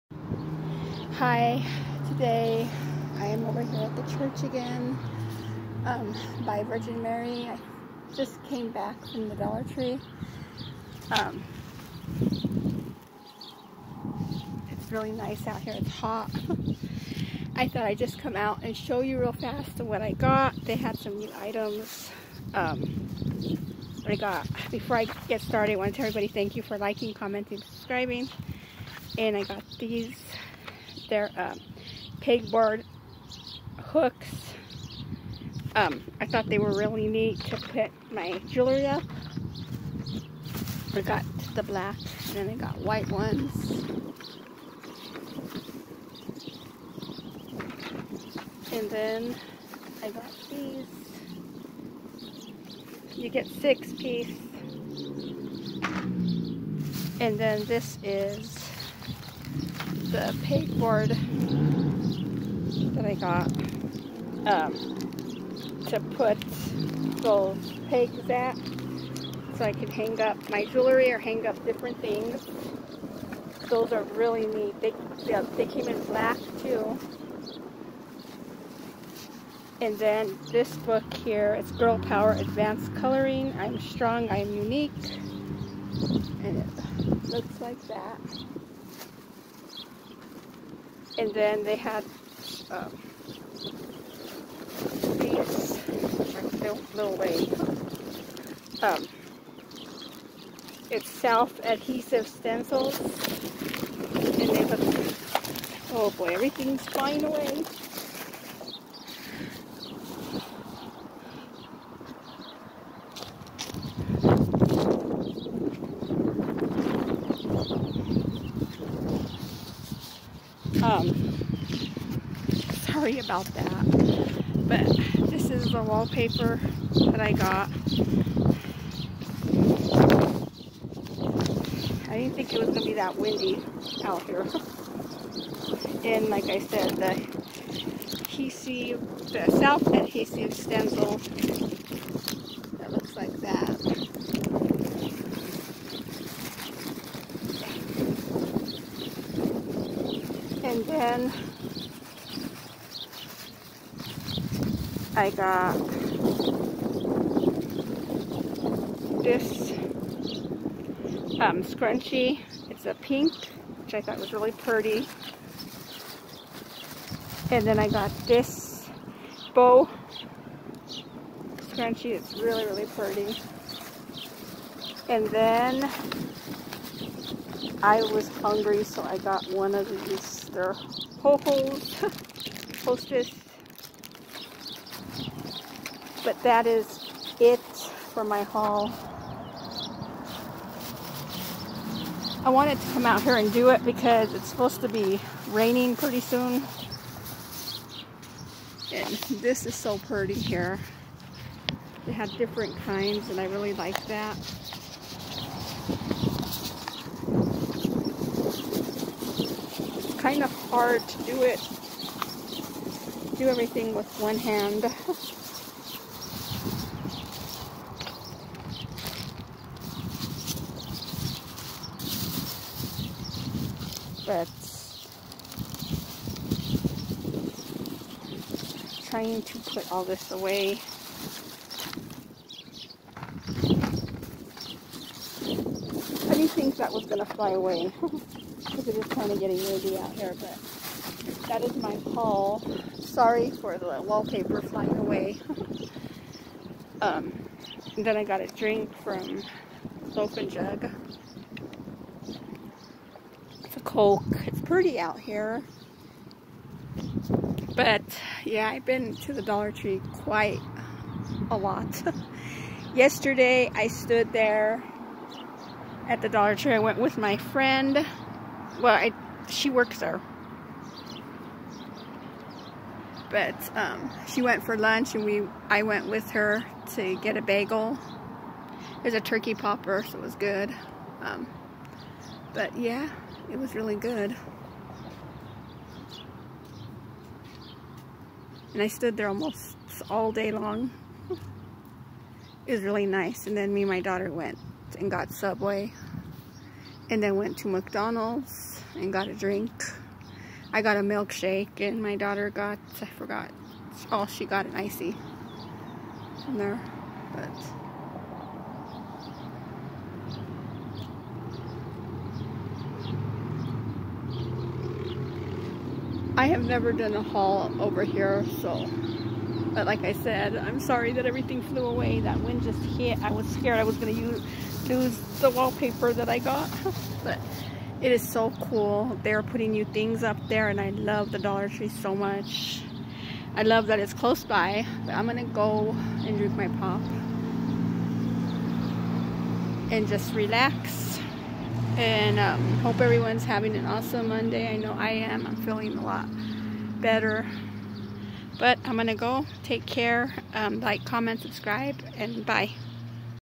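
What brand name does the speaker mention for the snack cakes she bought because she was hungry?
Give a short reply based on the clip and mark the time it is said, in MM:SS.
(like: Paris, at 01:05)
Hostess, at 03:02.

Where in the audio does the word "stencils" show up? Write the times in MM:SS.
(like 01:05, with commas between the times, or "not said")
01:42, 02:20.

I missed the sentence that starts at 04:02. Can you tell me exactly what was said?
Sorry for the wallpaper flying away.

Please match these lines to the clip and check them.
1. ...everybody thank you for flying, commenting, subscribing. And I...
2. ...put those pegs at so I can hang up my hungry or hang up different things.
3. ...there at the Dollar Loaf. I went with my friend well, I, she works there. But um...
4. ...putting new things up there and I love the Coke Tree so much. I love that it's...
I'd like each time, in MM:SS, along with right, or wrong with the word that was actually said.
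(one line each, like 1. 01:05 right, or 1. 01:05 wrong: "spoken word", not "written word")
1. 00:26 wrong: "liking", not "flying"
2. 01:06 wrong: "jewelry", not "hungry"
3. 04:24 wrong: "Tree", not "Loaf"
4. 05:29 wrong: "Dollar", not "Coke".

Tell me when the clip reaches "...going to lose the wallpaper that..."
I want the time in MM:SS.
05:23.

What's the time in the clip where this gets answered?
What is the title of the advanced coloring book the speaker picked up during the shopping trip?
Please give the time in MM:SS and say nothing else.
01:21.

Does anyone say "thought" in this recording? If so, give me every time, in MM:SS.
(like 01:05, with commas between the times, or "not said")
00:17, 00:36, 02:44.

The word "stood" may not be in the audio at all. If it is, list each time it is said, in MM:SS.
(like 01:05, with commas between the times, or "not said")
04:23, 04:48.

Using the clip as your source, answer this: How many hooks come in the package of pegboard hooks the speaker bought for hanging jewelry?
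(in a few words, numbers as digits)
6.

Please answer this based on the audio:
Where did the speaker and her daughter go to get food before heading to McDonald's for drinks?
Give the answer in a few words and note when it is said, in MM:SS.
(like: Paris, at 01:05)
Subway, at 04:55.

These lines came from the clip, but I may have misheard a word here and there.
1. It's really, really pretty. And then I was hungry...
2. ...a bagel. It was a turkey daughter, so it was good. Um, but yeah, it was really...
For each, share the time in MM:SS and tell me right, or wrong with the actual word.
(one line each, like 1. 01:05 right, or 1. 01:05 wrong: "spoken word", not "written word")
1. 02:52 right
2. 04:37 wrong: "popper", not "daughter".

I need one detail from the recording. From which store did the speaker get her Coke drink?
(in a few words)
Loaf and Jug.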